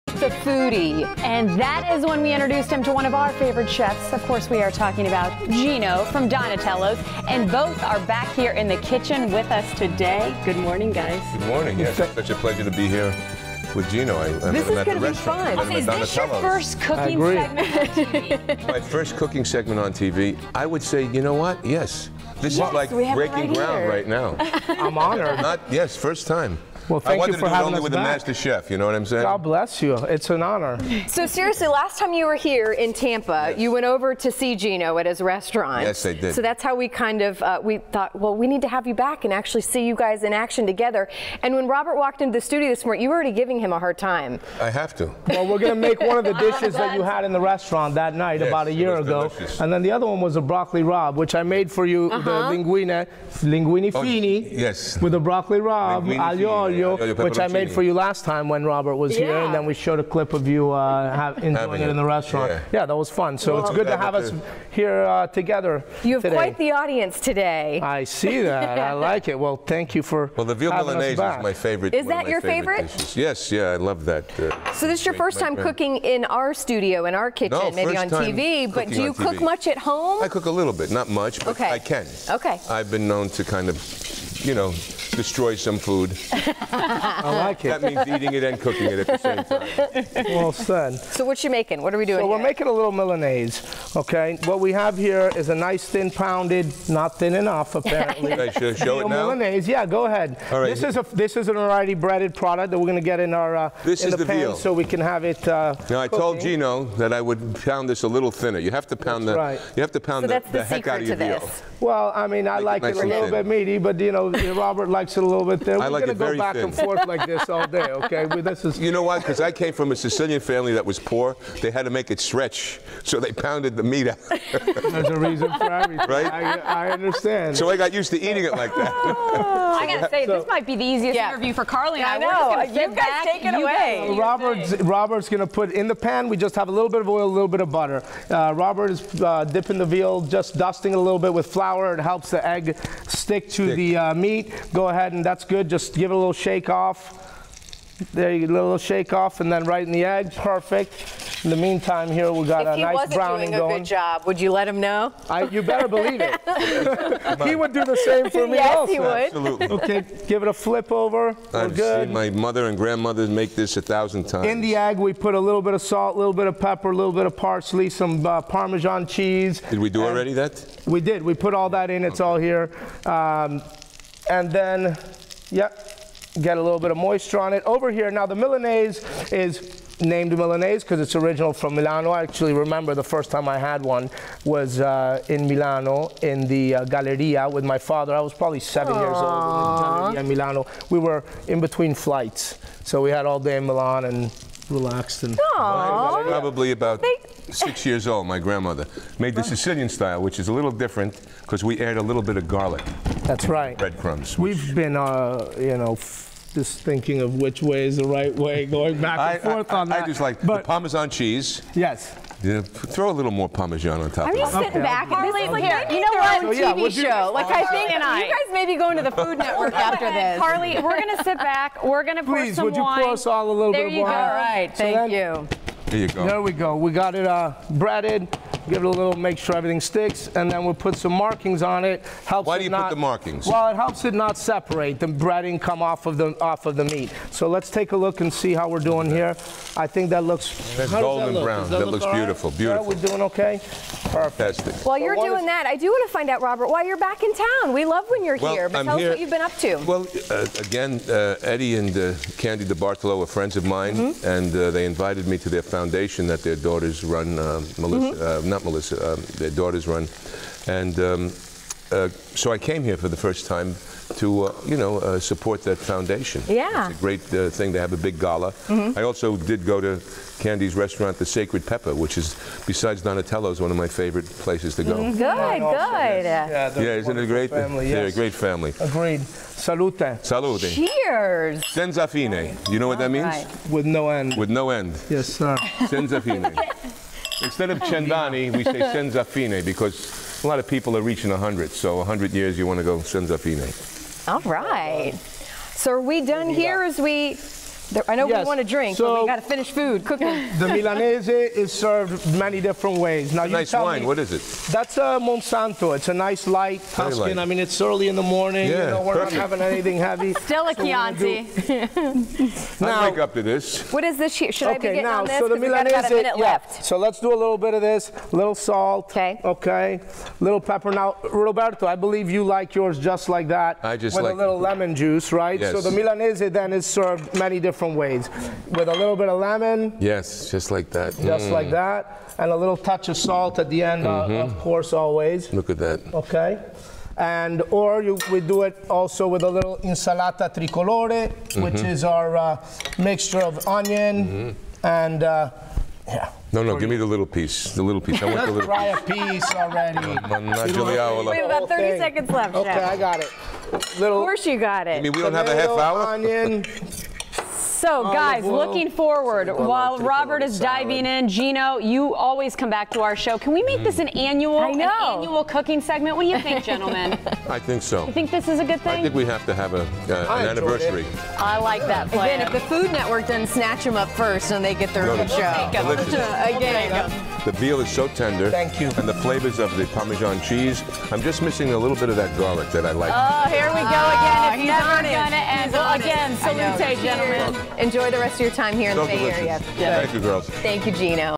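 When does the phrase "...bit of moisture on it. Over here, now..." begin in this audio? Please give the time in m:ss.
2:56.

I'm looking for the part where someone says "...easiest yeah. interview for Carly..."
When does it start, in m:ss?
2:10.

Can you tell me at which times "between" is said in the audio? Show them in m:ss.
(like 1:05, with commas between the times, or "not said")
3:11.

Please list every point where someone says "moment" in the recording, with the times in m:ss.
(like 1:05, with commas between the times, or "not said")
not said.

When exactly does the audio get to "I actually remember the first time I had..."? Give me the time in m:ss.
3:02.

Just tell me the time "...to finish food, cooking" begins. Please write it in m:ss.
4:59.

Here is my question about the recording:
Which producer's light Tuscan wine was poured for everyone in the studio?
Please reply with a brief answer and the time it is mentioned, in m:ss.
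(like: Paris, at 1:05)
Monsanto, at 5:05.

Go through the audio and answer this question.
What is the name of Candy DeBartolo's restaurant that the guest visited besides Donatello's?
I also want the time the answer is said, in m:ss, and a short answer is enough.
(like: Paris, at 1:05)
The Sacred Pepper, at 4:31.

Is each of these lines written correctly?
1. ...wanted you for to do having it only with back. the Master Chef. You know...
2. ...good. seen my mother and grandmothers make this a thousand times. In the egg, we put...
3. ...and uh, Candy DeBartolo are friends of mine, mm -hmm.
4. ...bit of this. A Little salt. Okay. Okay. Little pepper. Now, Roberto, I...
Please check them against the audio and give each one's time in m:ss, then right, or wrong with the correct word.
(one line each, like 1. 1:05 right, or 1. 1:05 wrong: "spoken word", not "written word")
1. 0:27 right
2. 2:41 right
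3. 4:11 right
4. 5:17 right.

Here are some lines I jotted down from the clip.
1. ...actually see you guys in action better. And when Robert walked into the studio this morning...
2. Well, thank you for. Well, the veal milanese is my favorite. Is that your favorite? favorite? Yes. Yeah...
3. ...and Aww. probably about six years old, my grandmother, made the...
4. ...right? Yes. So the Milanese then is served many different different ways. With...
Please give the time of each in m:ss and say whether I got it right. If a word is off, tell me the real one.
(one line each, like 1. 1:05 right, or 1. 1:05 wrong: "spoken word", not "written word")
1. 0:39 wrong: "together", not "better"
2. 1:09 right
3. 3:15 right
4. 5:25 right.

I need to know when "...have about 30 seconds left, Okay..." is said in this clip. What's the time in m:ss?
5:51.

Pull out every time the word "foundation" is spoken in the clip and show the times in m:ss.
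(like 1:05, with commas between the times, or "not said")
4:15, 4:25.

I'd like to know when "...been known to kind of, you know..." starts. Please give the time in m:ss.
1:22.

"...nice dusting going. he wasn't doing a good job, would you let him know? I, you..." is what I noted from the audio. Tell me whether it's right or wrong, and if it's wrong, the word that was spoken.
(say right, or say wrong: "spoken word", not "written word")
wrong: "browning", not "dusting".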